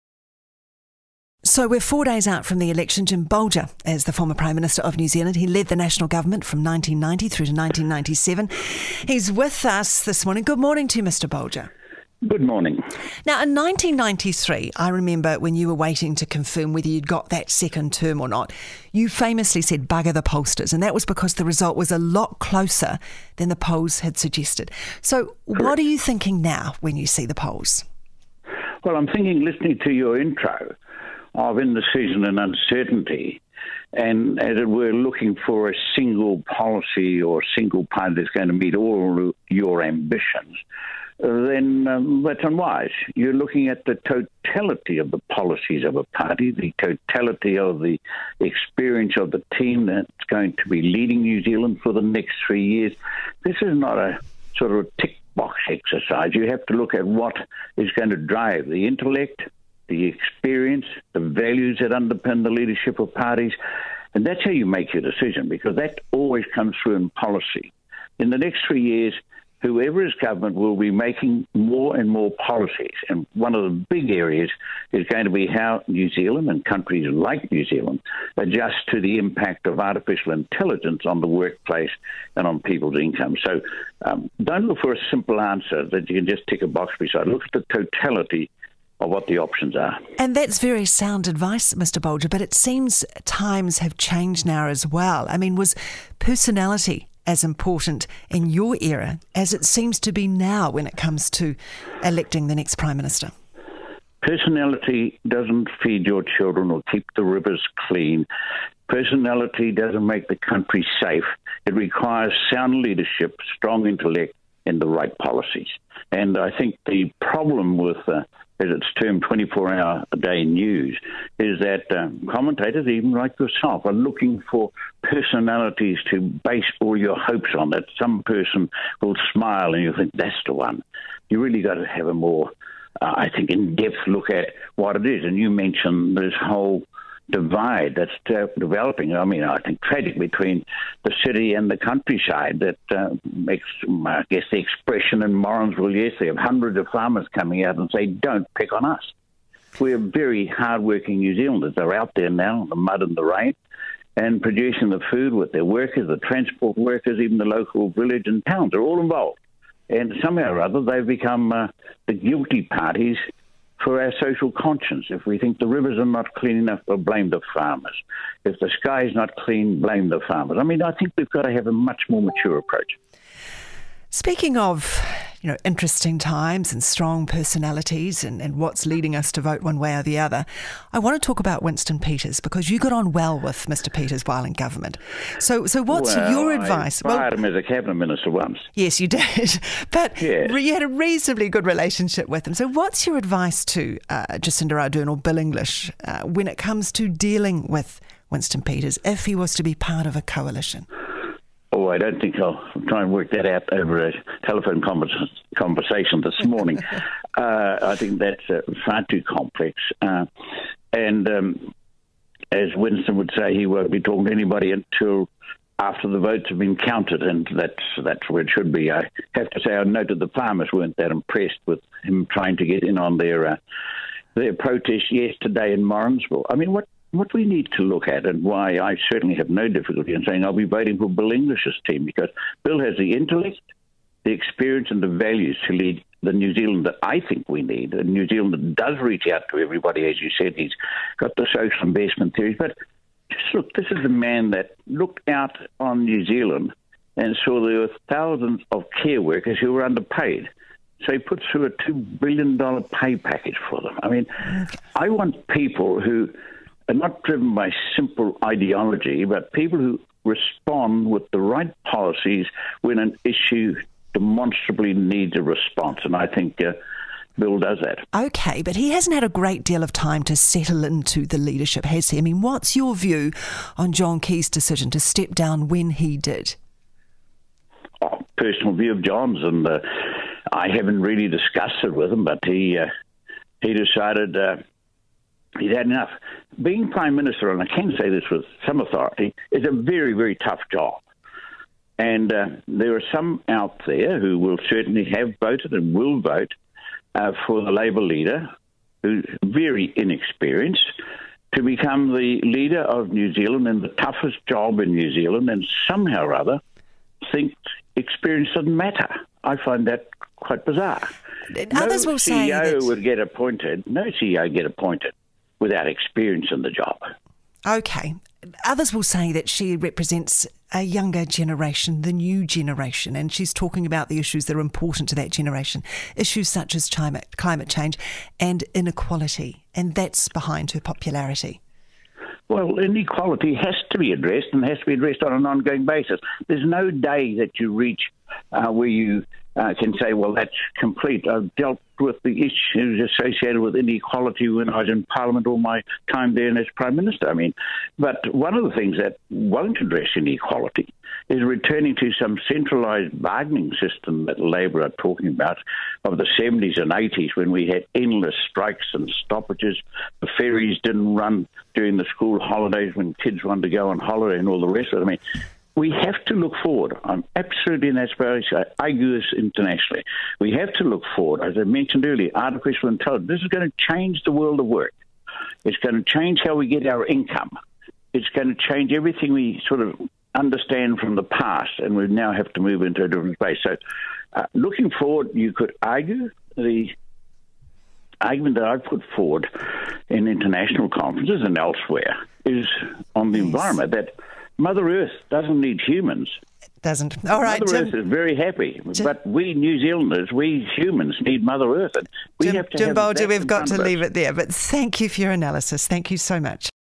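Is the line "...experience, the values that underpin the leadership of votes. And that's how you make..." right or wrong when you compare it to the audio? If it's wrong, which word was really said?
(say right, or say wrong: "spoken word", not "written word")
wrong: "parties", not "votes".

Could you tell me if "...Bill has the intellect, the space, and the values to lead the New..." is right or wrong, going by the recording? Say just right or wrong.
wrong.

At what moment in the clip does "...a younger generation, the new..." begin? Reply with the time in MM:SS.
05:20.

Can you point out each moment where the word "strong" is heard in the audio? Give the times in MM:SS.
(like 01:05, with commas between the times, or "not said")
01:53, 02:56.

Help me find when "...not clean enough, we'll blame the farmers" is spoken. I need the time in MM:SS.
02:46.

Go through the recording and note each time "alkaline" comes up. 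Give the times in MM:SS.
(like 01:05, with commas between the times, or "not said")
not said.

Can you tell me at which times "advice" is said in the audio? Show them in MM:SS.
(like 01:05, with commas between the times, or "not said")
01:31, 03:06, 03:13.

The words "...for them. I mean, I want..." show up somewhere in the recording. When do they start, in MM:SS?
04:13.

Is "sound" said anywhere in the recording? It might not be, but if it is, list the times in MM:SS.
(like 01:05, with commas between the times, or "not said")
01:30, 01:52.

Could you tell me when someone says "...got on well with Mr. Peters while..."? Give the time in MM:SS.
03:02.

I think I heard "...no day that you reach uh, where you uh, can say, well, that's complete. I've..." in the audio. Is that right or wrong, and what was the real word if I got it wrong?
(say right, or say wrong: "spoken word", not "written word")
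right.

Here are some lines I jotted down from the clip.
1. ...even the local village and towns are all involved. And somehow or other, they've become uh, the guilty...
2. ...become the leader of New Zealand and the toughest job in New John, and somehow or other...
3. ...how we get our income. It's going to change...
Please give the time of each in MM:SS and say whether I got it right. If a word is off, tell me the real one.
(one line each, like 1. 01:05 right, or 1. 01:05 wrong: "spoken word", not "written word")
1. 02:37 right
2. 05:01 wrong: "Zealand", not "John"
3. 06:16 right.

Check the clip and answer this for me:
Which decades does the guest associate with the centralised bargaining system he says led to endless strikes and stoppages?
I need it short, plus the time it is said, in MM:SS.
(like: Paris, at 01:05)
the 70s and 80s, at 05:56.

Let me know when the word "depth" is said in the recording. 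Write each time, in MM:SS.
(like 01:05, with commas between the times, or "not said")
02:13.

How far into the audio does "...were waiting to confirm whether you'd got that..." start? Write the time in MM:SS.
00:15.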